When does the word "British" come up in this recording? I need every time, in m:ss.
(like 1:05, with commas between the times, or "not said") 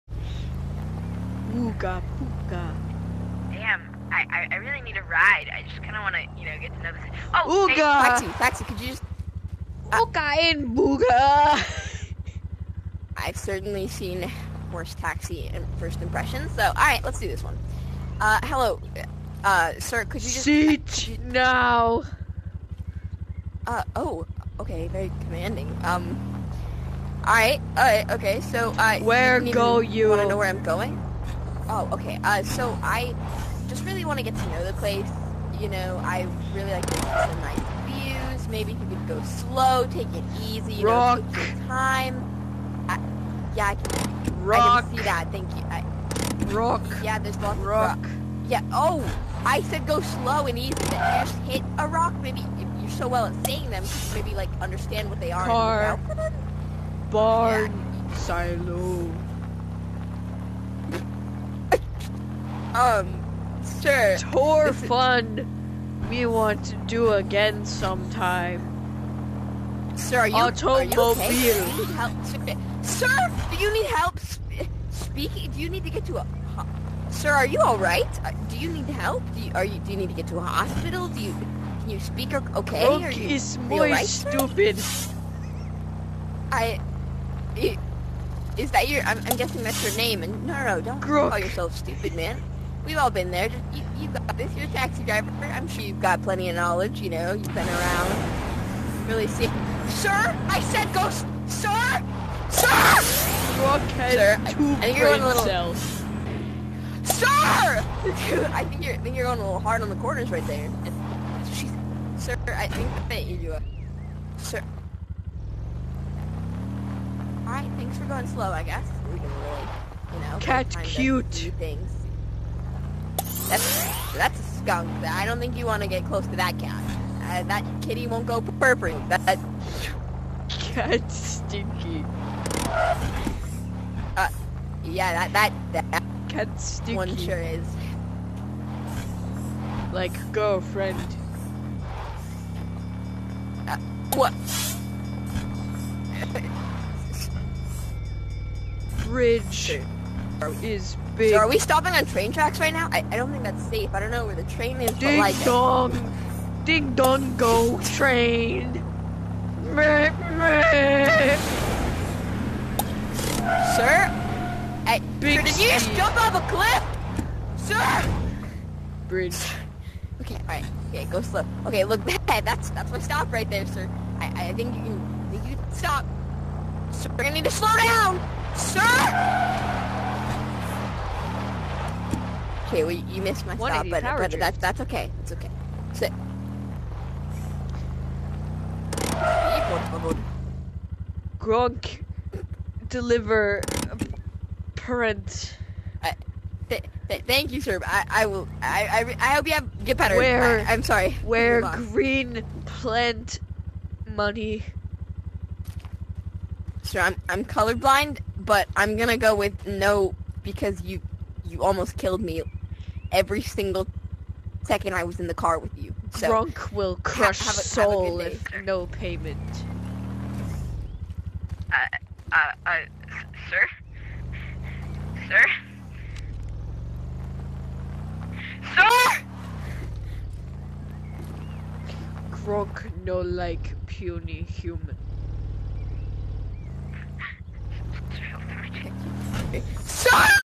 not said.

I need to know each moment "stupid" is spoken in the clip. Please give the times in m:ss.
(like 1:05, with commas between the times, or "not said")
1:24, 1:31.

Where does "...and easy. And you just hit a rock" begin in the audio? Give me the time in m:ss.
0:50.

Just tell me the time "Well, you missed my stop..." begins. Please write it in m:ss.
3:02.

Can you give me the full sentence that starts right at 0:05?
I just kind of want to, you know, get to know this.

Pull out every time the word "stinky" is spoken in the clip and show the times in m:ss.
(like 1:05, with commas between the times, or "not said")
2:11, 2:16.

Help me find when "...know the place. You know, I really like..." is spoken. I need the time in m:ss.
0:34.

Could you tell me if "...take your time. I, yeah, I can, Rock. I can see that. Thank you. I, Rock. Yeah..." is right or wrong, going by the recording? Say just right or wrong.
right.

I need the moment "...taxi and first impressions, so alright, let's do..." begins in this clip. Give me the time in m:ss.
0:14.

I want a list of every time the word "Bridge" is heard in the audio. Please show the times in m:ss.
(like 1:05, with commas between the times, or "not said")
2:29, 2:49.